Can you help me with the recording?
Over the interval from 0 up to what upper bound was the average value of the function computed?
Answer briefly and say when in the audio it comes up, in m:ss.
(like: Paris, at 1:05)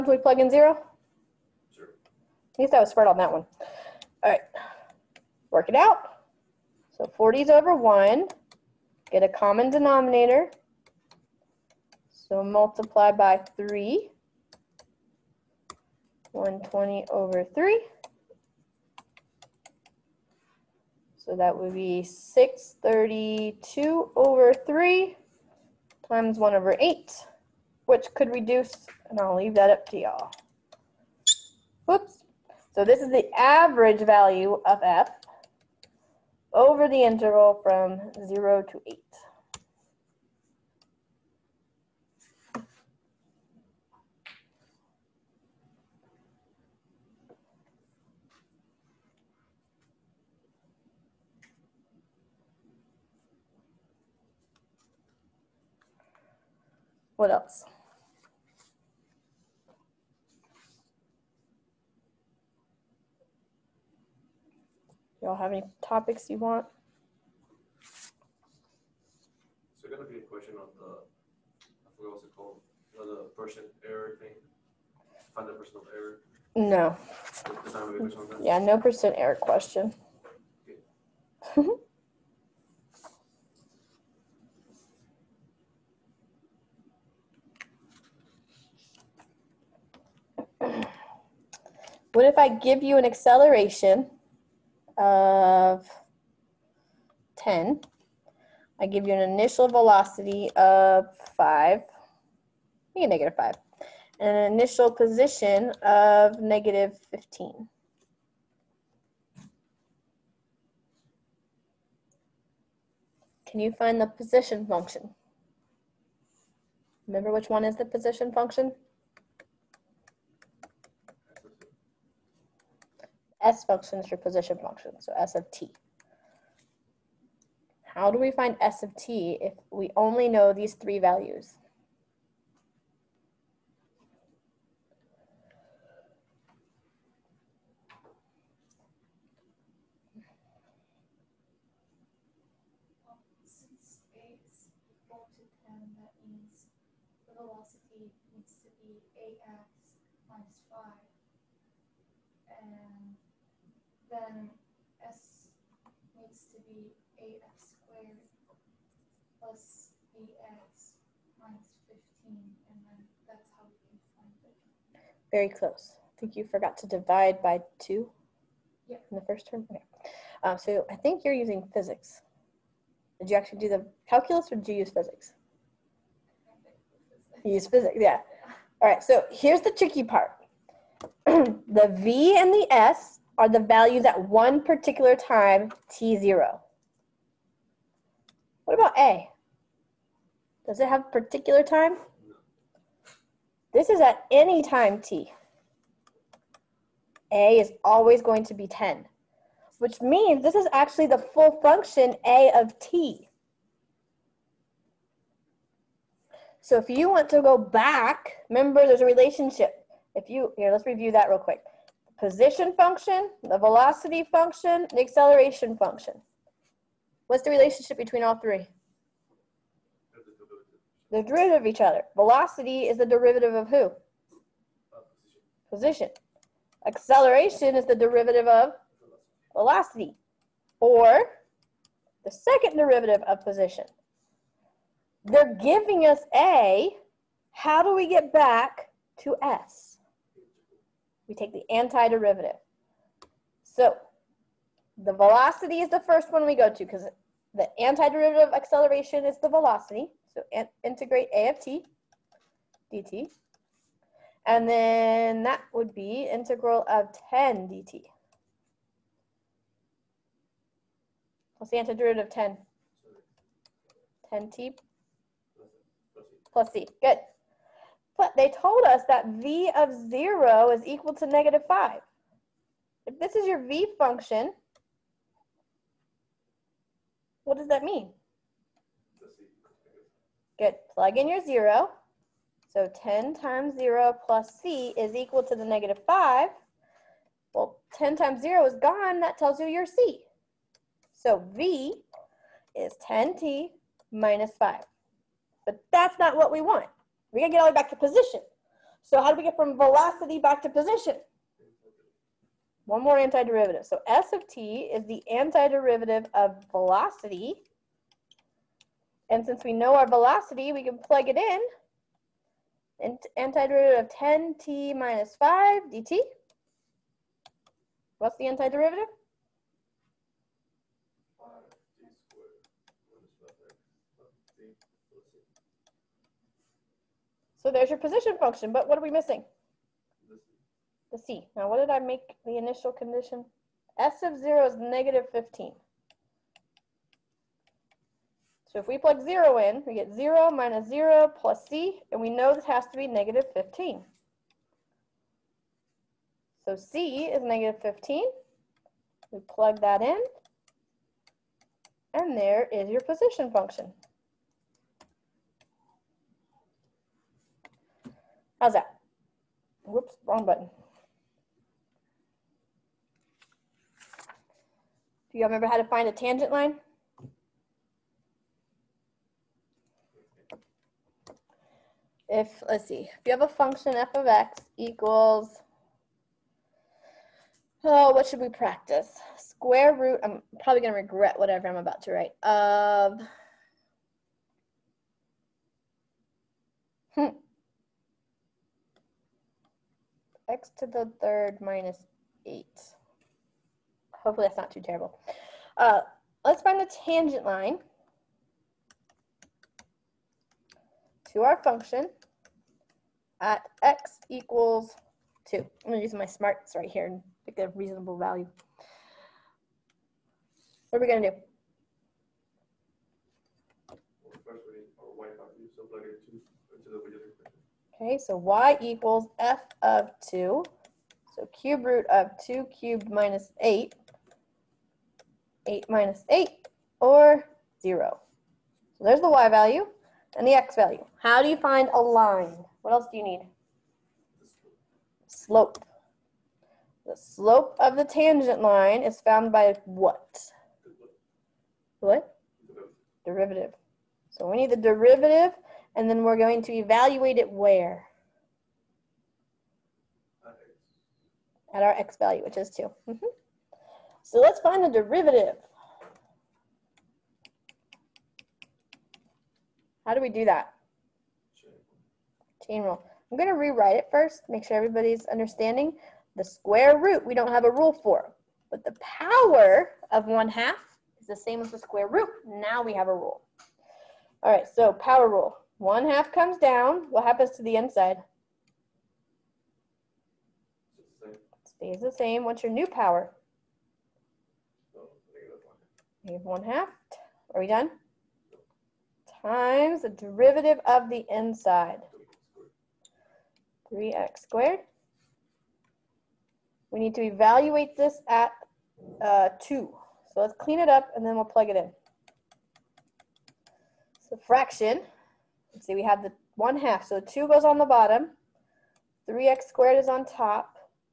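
8, at 0:38.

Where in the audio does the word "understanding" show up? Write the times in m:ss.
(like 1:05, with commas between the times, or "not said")
7:45.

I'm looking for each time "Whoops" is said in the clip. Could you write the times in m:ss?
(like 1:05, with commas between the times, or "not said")
0:31, 5:59.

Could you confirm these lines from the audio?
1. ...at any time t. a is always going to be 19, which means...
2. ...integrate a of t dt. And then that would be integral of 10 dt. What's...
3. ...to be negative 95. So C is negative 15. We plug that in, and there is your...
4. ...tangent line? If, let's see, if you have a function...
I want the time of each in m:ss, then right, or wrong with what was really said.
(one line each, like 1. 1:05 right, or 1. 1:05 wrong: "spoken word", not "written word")
1. 3:14 wrong: "10", not "19"
2. 4:10 right
3. 5:42 wrong: "15", not "95"
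4. 6:06 right.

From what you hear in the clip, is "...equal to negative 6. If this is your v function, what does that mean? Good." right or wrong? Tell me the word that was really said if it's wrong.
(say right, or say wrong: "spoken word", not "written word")
wrong: "5", not "6".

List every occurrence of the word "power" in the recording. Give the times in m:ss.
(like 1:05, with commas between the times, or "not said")
7:49, 7:54, 8:02.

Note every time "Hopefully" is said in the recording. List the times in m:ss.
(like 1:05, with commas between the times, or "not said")
6:34.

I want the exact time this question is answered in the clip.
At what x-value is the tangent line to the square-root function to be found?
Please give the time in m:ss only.
6:43.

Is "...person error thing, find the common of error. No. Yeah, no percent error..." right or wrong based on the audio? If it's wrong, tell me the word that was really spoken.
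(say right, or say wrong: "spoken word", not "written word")
wrong: "person", not "common".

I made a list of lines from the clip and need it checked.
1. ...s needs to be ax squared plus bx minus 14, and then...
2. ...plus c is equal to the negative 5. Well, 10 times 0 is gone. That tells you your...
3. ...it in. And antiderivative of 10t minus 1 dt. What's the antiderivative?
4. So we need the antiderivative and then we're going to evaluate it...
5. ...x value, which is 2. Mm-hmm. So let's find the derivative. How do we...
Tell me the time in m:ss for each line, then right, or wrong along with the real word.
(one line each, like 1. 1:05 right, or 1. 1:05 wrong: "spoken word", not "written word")
1. 2:35 wrong: "15", not "14"
2. 4:44 right
3. 5:11 wrong: "5", not "1"
4. 7:24 wrong: "derivative", not "antiderivative"
5. 7:31 right.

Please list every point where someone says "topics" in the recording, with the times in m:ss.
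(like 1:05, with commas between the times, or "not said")
1:05.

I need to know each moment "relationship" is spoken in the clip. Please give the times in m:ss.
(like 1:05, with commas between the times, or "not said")
3:29, 3:37.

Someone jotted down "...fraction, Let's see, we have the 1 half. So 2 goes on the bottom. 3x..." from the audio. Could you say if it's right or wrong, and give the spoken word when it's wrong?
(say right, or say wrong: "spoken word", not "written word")
right.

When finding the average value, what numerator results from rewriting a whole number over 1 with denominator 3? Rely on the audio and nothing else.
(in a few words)
120.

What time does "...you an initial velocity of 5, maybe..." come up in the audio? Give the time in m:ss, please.
1:39.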